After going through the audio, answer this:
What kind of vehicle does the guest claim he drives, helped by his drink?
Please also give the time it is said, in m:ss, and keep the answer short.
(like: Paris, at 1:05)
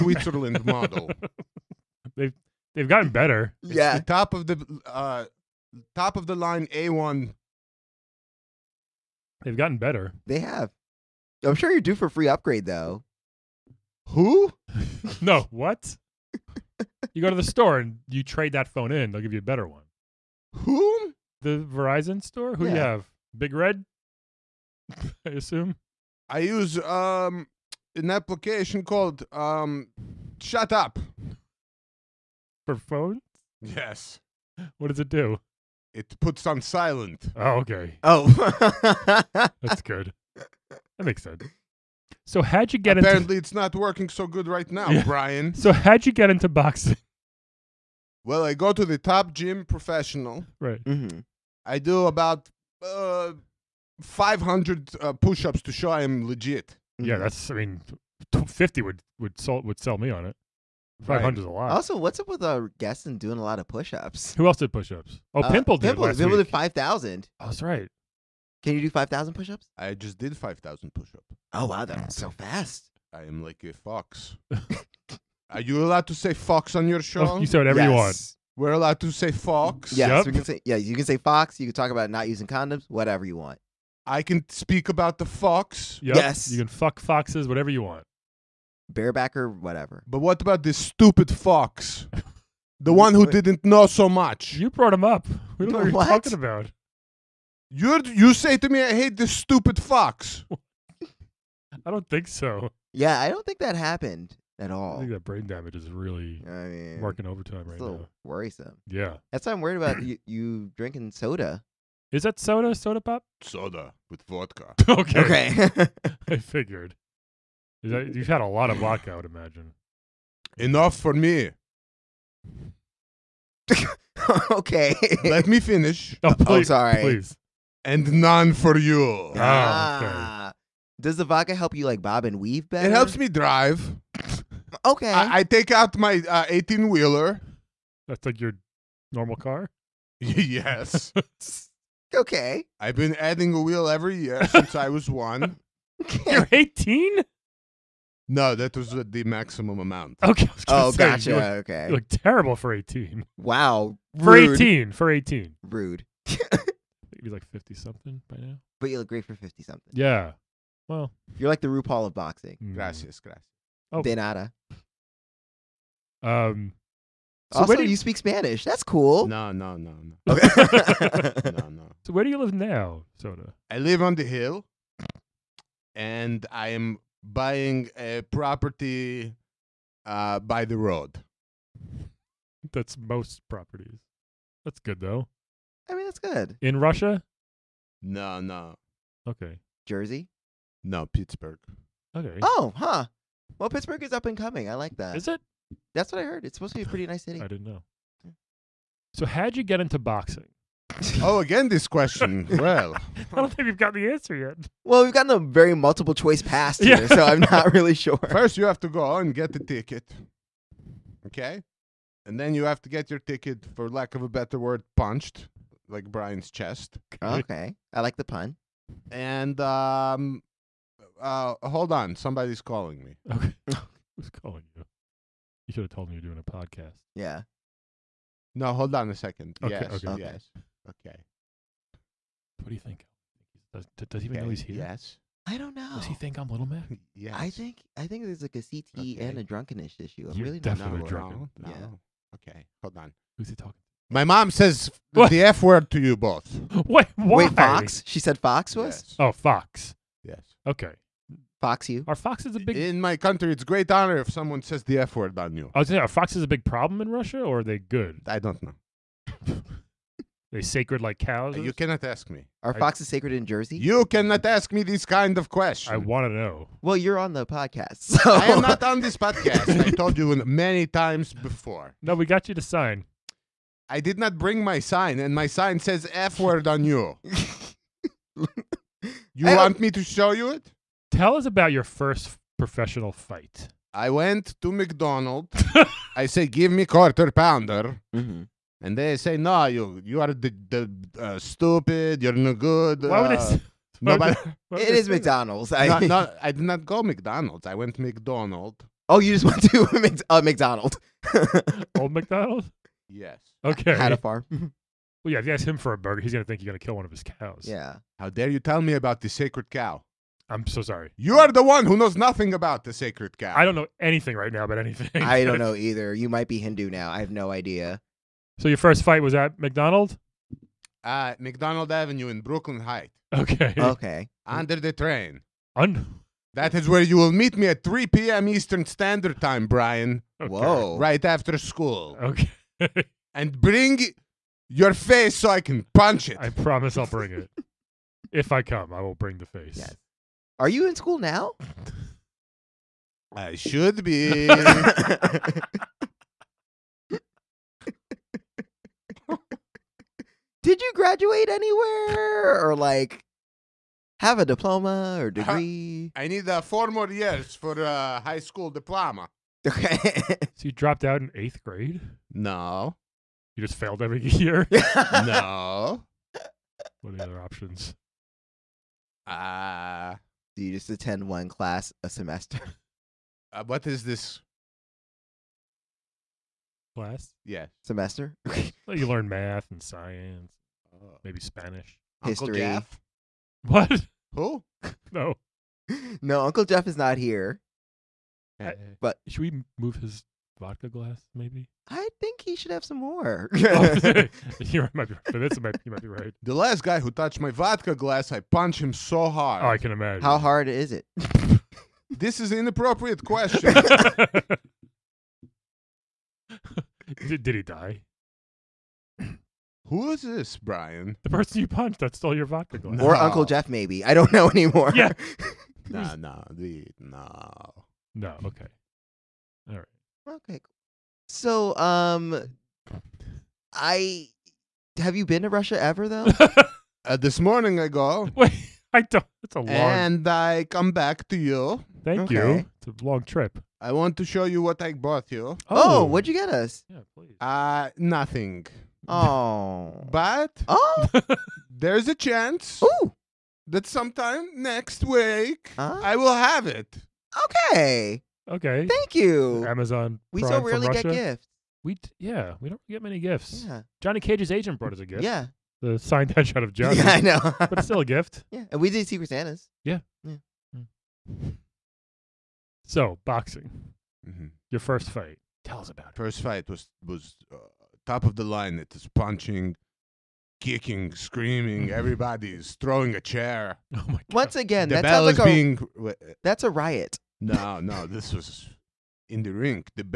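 18 wheeler, at 2:16.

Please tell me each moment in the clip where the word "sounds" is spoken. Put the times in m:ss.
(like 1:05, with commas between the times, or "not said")
7:55.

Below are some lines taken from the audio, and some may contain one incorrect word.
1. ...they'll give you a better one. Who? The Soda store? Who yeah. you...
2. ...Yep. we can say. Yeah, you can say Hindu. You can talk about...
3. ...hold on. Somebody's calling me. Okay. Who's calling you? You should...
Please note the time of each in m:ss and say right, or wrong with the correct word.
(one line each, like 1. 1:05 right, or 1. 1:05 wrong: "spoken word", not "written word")
1. 0:19 wrong: "Verizon", not "Soda"
2. 1:20 wrong: "Fox", not "Hindu"
3. 3:41 right.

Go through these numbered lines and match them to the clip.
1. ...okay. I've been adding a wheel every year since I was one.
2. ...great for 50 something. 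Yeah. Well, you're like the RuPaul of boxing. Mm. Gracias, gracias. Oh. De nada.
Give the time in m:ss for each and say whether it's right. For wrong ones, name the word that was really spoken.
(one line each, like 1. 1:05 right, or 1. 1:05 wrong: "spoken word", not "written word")
1. 2:22 right
2. 2:39 right.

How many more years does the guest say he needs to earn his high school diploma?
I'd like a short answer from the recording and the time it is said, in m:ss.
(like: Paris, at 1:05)
4, at 5:56.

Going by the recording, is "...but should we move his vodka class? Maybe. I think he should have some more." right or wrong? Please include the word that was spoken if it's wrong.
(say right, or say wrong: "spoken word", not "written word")
wrong: "glass", not "class".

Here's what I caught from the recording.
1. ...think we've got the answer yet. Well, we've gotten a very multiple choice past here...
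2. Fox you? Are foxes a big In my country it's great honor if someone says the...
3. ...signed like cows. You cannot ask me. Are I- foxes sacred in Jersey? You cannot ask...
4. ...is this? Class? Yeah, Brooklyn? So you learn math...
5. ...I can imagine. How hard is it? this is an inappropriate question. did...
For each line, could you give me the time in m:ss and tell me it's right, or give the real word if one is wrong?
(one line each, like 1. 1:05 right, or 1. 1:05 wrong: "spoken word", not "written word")
1. 3:23 right
2. 4:11 right
3. 4:20 wrong: "sacred", not "signed"
4. 6:13 wrong: "Semester", not "Brooklyn"
5. 6:39 right.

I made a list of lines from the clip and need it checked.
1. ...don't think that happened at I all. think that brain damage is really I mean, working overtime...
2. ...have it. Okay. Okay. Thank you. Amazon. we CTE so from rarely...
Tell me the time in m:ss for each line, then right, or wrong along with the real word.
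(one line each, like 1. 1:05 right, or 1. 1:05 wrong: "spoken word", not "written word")
1. 1:43 right
2. 7:26 wrong: "Prime", not "CTE".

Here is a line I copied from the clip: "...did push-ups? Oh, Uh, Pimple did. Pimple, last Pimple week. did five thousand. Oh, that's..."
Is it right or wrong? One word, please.
right.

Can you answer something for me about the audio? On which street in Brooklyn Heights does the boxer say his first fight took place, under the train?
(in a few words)
McDonald Avenue.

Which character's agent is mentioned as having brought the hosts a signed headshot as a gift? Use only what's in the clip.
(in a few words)
Johnny Cage.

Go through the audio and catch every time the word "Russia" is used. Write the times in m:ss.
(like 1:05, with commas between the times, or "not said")
3:06, 4:17, 7:05.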